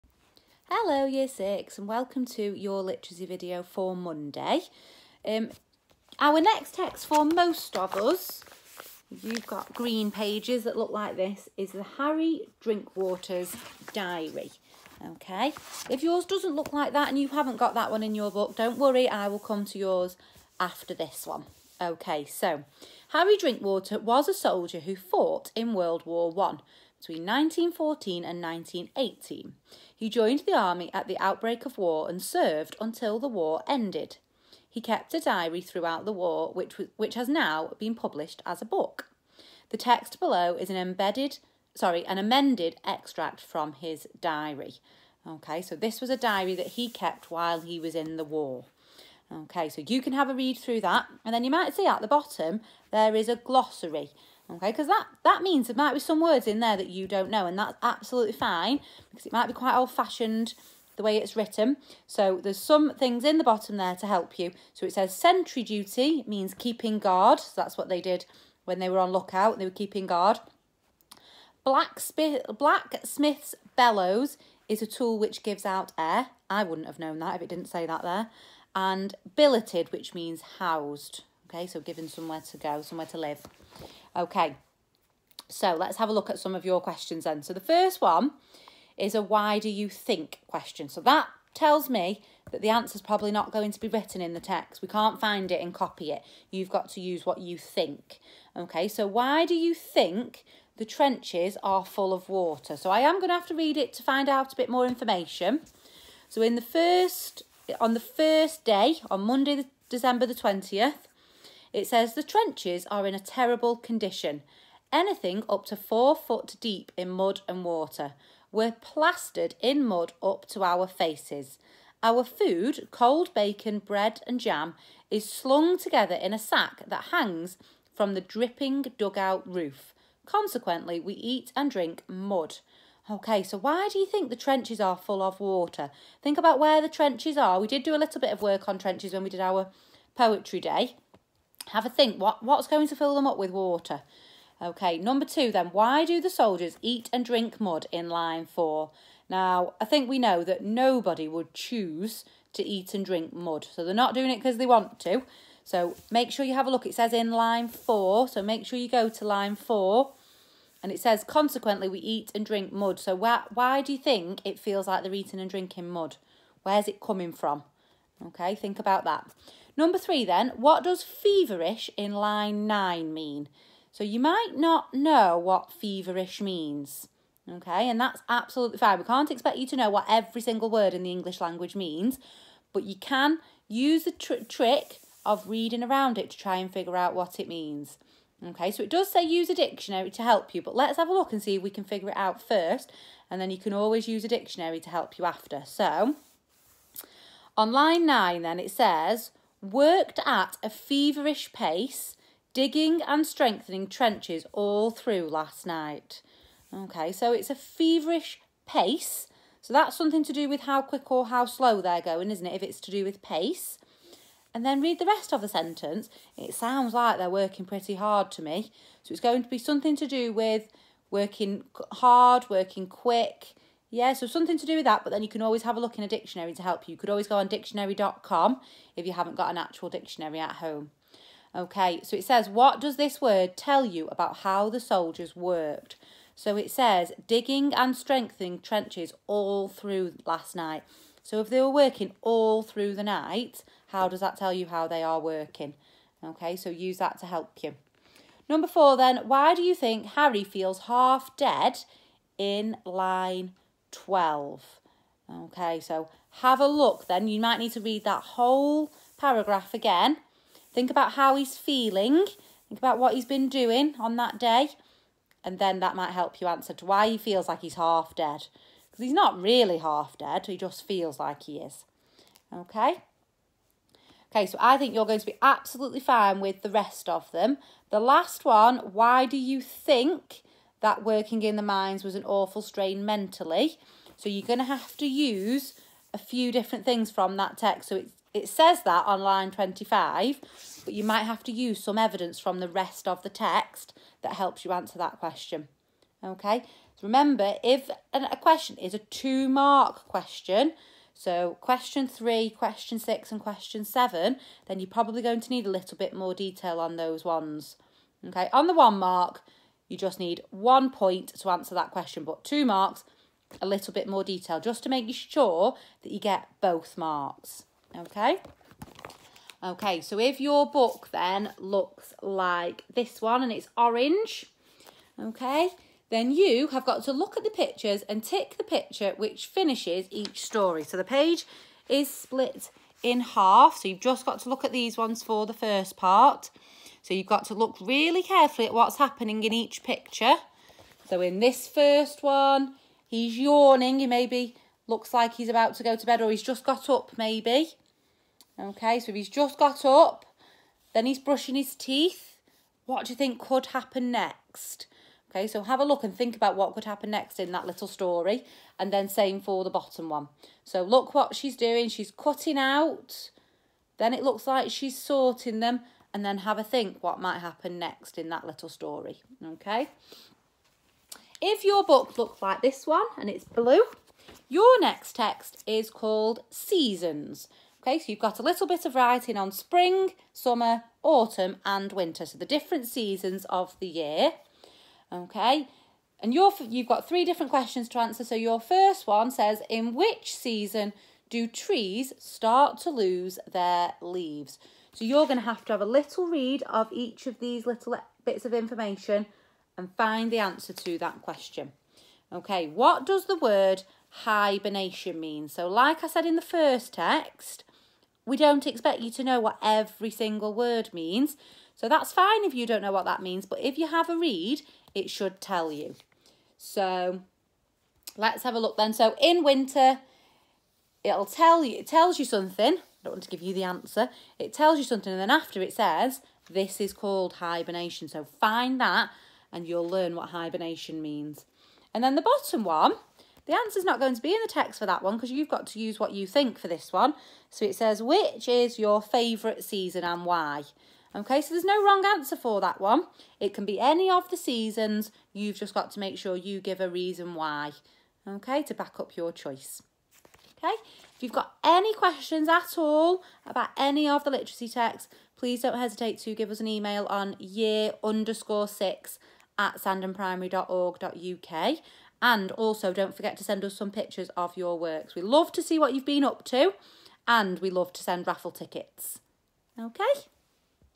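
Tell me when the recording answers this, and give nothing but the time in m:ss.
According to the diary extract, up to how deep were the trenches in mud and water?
1:55.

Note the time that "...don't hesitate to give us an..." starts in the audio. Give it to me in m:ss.
7:35.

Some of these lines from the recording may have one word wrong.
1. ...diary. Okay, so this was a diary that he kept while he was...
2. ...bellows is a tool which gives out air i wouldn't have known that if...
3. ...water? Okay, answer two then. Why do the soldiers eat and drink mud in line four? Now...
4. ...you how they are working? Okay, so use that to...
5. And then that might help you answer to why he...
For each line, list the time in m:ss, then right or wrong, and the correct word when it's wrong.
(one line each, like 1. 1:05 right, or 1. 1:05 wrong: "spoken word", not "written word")
1. 0:44 right
2. 1:13 right
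3. 2:23 wrong: "number", not "answer"
4. 4:04 right
5. 4:25 right.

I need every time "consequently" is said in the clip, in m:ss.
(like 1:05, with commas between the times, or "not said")
2:10, 2:41.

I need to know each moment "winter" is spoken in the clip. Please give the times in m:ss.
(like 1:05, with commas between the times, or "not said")
6:21, 6:59.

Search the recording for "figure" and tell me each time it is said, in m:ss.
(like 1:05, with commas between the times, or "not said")
3:06, 3:11.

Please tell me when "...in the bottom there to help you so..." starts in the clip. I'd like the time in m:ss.
1:03.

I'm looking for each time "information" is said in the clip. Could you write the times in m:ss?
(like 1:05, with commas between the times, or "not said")
1:44, 6:38.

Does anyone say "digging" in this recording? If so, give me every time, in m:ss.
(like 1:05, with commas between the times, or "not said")
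3:22, 3:57.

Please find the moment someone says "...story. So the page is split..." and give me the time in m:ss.
5:30.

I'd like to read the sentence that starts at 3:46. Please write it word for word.
You could always go on dictionary.com if you haven't got an actual dictionary at home.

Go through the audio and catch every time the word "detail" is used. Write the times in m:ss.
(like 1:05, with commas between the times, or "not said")
5:06, 5:14.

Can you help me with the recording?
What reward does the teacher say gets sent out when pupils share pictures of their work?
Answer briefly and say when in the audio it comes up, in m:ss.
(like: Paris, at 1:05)
Raffle tickets, at 7:48.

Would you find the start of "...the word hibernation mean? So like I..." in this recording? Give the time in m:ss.
6:43.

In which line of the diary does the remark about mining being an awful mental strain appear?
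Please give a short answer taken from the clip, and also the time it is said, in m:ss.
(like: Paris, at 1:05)
Line 25, at 4:49.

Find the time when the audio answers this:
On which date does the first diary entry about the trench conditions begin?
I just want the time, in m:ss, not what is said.
1:49.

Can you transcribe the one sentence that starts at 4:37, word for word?
The last one, why do you think that working in the mines was an awful strain mentally.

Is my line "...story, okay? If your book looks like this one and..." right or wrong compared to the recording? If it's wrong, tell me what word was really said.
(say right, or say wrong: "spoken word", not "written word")
right.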